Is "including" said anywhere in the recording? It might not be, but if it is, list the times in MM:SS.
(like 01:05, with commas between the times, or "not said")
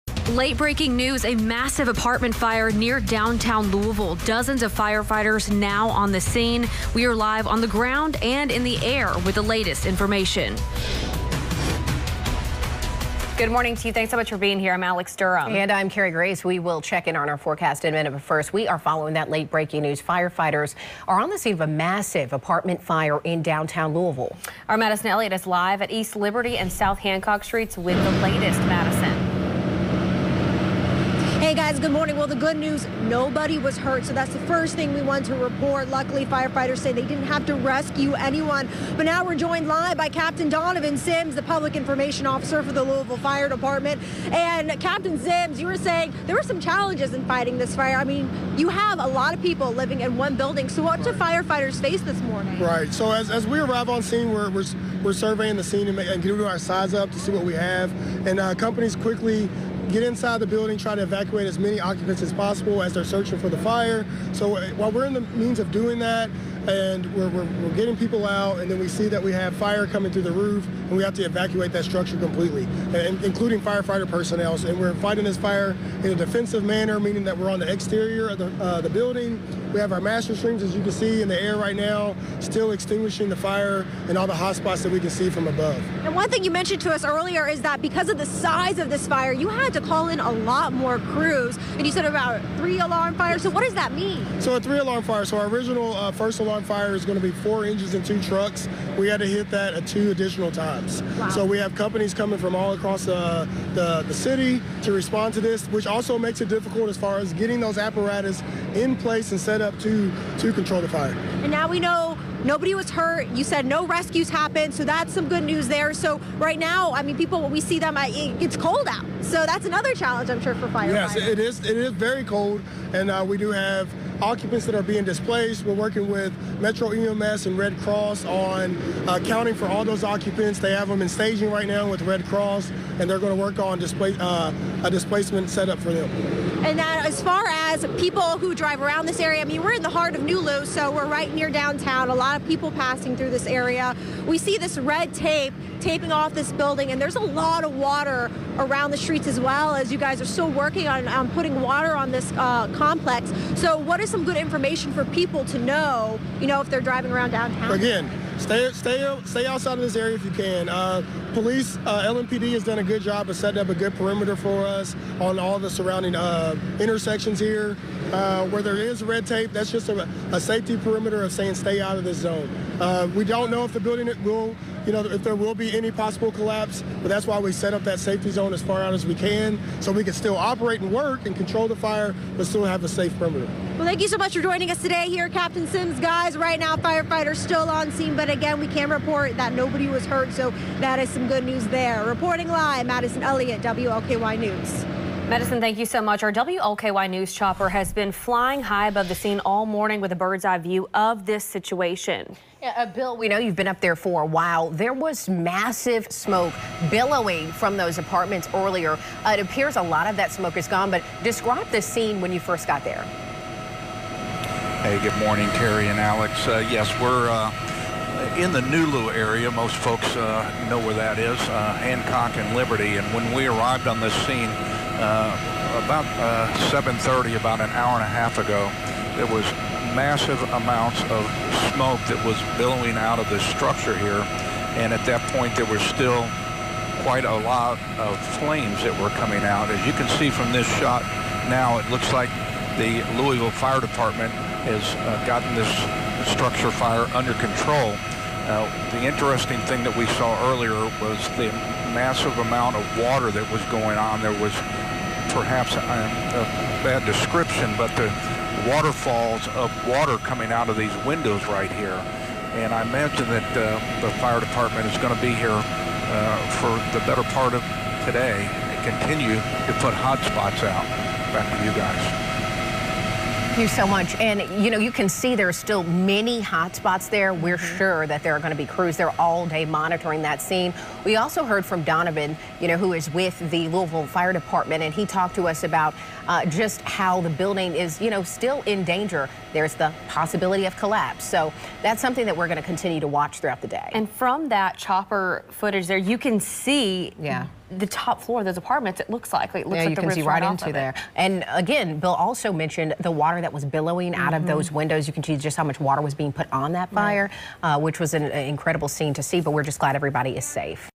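01:13.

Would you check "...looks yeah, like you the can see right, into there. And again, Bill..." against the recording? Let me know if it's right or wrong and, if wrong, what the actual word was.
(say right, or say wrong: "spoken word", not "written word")
right.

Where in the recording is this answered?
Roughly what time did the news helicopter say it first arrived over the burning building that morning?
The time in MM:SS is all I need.
03:46.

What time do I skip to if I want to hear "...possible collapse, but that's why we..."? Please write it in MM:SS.
02:55.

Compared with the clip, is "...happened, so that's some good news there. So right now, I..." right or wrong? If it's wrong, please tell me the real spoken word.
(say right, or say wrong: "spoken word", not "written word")
right.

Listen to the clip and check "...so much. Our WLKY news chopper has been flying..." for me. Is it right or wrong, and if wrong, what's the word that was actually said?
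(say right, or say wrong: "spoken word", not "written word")
right.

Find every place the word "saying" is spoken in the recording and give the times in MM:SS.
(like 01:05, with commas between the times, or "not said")
00:45, 02:51.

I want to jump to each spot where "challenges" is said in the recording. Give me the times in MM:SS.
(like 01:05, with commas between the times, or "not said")
00:46, 01:59.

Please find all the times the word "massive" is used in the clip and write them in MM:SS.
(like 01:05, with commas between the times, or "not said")
00:01, 00:21, 03:25, 03:49, 04:11.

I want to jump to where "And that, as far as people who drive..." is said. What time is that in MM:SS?
02:16.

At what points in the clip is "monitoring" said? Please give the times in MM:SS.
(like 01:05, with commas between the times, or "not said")
04:39.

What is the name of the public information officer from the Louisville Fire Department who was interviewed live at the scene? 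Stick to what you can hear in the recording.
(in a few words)
Donovan Sims.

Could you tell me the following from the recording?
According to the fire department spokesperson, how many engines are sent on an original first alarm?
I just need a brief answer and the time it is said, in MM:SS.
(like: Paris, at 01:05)
4, at 01:37.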